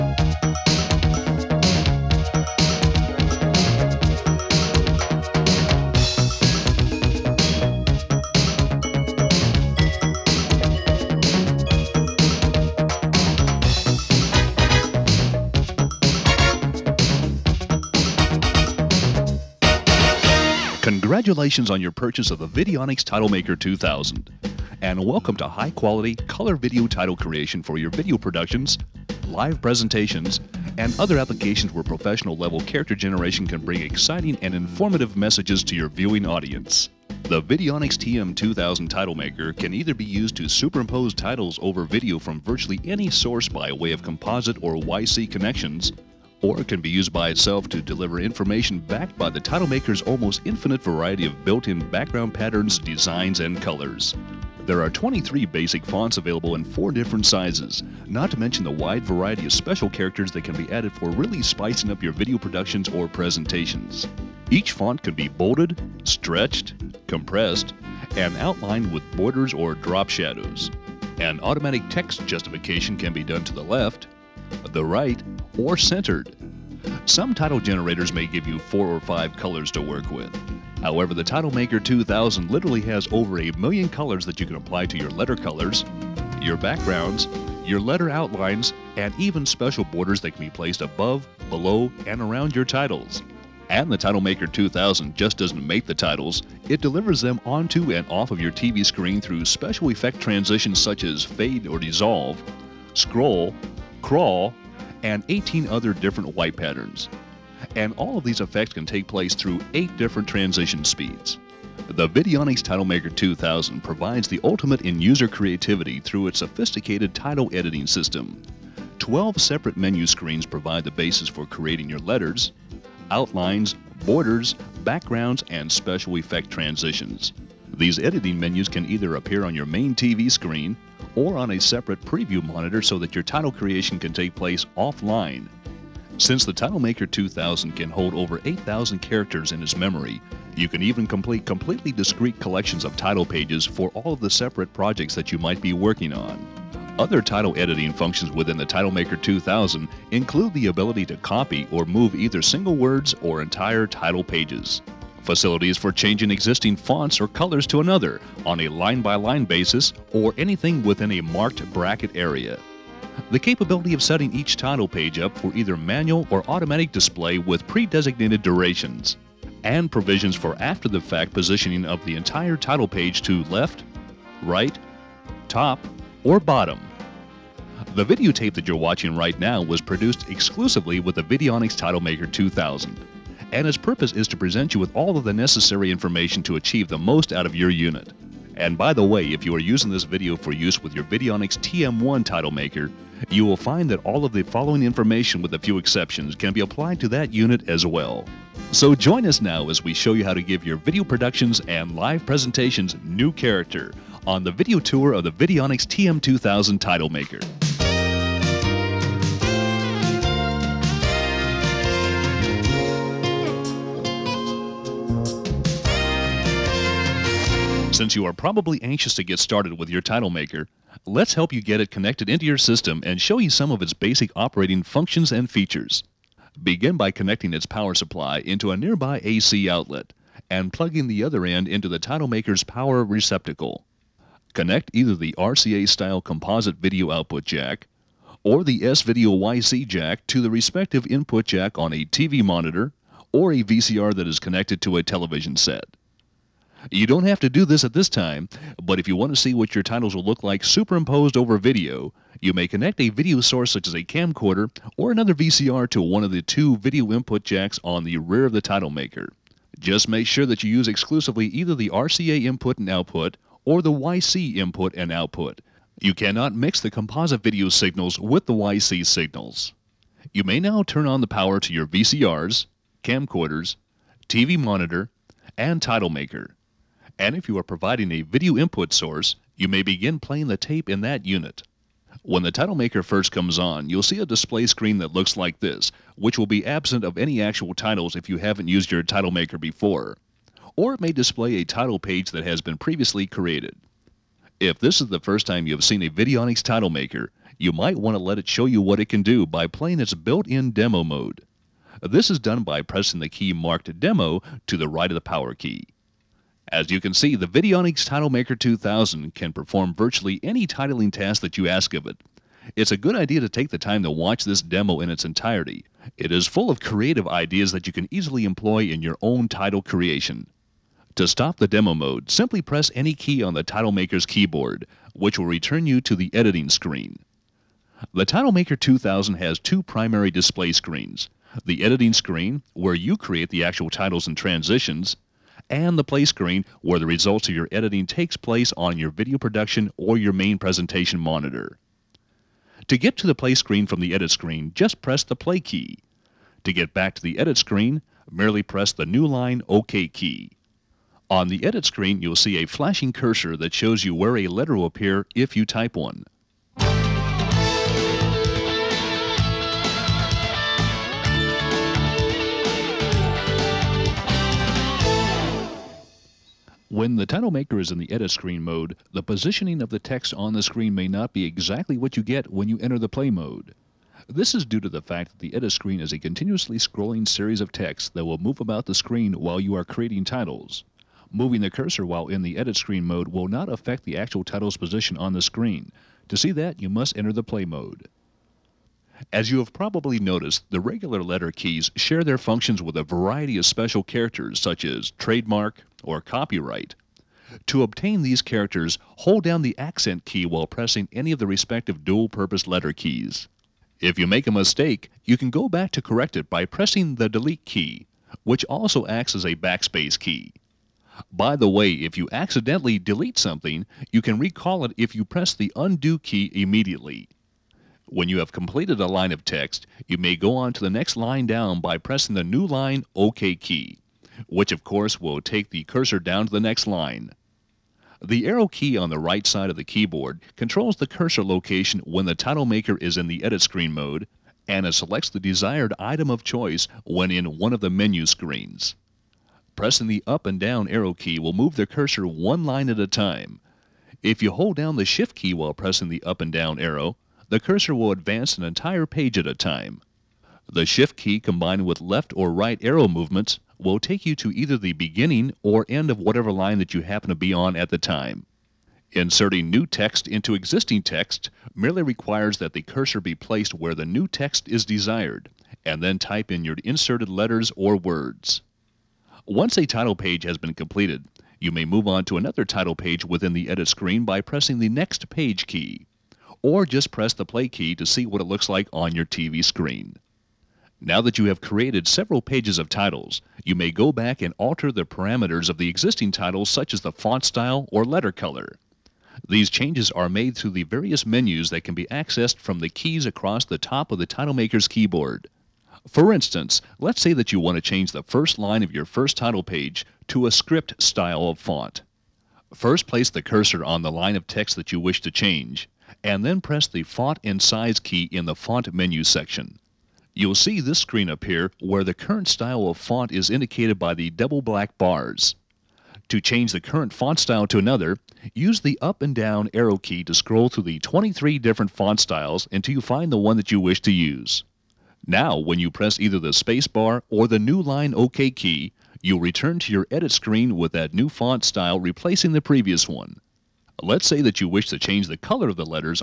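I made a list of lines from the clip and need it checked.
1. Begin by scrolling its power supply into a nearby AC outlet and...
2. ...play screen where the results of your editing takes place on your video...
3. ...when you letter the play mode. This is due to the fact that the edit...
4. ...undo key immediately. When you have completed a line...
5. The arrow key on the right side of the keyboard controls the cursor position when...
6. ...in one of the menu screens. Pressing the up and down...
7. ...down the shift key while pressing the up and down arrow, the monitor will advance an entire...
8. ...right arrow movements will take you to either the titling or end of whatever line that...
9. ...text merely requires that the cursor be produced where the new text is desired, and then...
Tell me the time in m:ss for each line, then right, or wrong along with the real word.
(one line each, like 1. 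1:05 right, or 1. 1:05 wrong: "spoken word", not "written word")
1. 3:46 wrong: "connecting", not "scrolling"
2. 5:36 right
3. 6:12 wrong: "enter", not "letter"
4. 6:55 right
5. 7:08 wrong: "location", not "position"
6. 7:17 right
7. 7:24 wrong: "cursor", not "monitor"
8. 7:32 wrong: "beginning", not "titling"
9. 7:41 wrong: "placed", not "produced".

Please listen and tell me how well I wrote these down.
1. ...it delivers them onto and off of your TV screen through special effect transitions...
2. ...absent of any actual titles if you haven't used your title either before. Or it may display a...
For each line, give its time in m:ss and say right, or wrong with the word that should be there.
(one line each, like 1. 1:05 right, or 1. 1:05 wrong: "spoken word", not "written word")
1. 1:36 right
2. 4:46 wrong: "maker", not "either".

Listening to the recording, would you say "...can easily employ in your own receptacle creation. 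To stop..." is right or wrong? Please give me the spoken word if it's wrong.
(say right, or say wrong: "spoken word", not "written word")
wrong: "title", not "receptacle".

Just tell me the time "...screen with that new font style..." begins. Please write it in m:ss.
8:50.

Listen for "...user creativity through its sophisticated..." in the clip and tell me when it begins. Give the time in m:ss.
1:54.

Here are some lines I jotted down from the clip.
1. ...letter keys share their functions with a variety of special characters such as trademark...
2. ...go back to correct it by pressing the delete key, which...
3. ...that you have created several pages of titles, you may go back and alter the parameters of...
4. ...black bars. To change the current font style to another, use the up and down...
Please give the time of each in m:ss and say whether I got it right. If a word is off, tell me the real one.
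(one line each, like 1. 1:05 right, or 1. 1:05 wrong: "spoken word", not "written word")
1. 6:31 right
2. 6:45 right
3. 8:01 right
4. 8:34 right.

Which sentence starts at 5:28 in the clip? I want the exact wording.
The TitleMaker 2000 has two primary display screens.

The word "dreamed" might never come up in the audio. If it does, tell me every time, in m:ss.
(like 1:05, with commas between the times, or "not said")
not said.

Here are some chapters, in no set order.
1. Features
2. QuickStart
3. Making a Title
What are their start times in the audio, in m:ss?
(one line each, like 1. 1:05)
1. 0:18
2. 3:29
3. 6:00.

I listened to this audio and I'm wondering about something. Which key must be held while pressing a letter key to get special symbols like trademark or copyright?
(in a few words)
accent key.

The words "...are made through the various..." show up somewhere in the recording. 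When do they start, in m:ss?
8:10.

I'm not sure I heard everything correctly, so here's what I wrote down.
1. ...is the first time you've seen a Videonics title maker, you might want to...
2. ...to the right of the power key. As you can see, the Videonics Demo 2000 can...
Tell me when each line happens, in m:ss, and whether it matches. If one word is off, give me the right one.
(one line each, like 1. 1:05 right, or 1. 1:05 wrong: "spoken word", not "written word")
1. 4:55 right
2. 5:04 wrong: "TitleMaker", not "Demo".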